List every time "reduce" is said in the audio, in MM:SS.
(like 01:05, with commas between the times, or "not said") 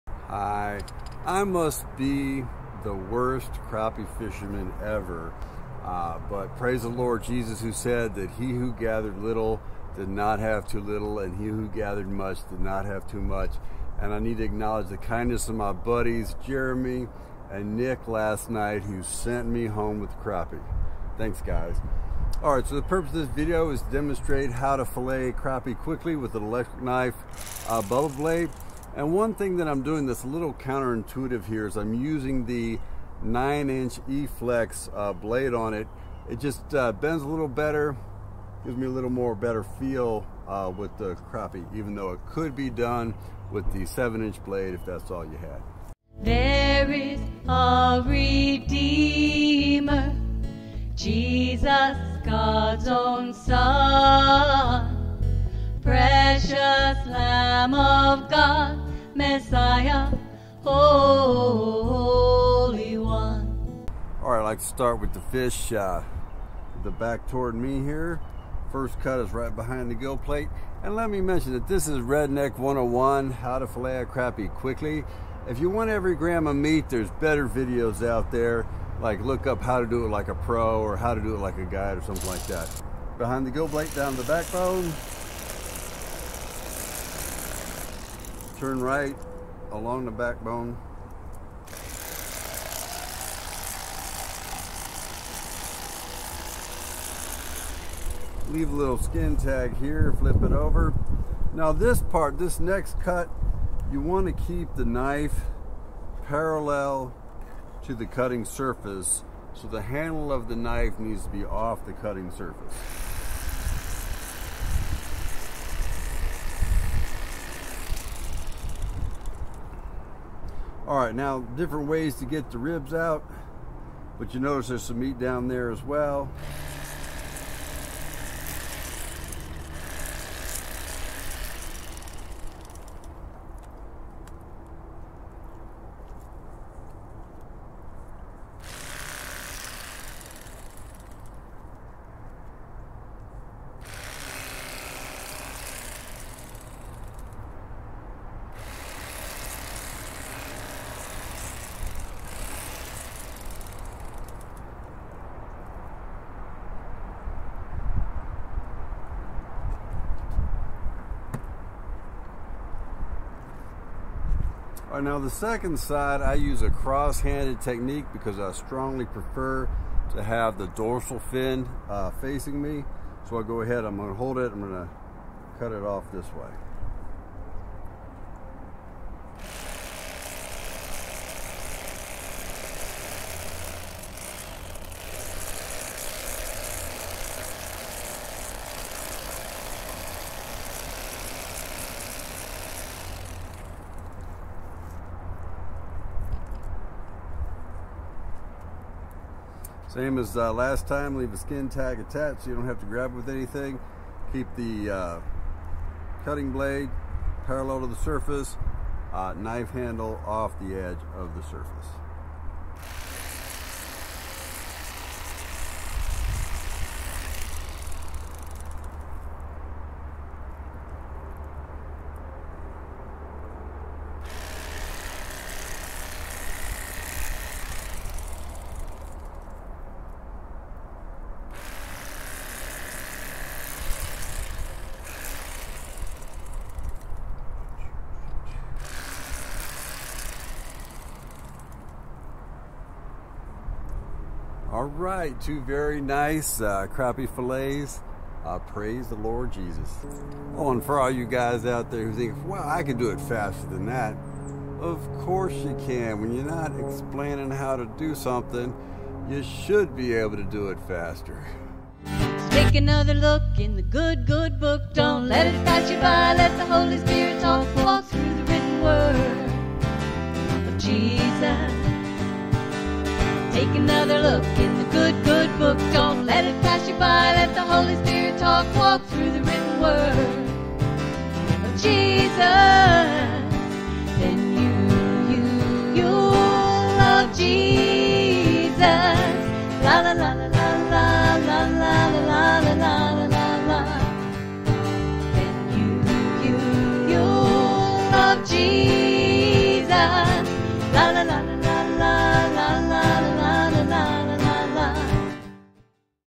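not said.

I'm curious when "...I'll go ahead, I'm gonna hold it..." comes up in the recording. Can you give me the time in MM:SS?
02:53.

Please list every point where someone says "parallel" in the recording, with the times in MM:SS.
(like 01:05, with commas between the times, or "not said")
01:46, 03:27.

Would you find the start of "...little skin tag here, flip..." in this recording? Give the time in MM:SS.
01:38.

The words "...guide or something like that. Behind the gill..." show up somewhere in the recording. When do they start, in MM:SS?
01:21.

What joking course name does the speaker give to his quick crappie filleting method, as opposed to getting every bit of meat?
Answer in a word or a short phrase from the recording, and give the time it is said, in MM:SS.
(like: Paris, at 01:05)
Redneck 101, at 01:11.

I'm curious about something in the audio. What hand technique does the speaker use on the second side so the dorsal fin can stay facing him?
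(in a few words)
cross-handed.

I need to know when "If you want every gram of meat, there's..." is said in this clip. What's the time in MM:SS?
01:15.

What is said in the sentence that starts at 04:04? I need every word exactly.
All right, two very nice uh, crappie fillets.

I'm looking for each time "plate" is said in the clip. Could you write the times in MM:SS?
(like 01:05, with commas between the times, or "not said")
01:10, 01:23.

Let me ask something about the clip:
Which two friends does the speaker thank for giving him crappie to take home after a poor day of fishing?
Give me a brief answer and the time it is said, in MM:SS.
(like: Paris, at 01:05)
Jeremy and Nick, at 00:16.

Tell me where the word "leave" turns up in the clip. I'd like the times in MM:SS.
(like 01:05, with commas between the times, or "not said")
01:38, 03:21.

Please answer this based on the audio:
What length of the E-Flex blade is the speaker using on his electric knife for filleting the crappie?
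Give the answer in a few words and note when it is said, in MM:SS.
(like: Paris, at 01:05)
9-inch, at 00:33.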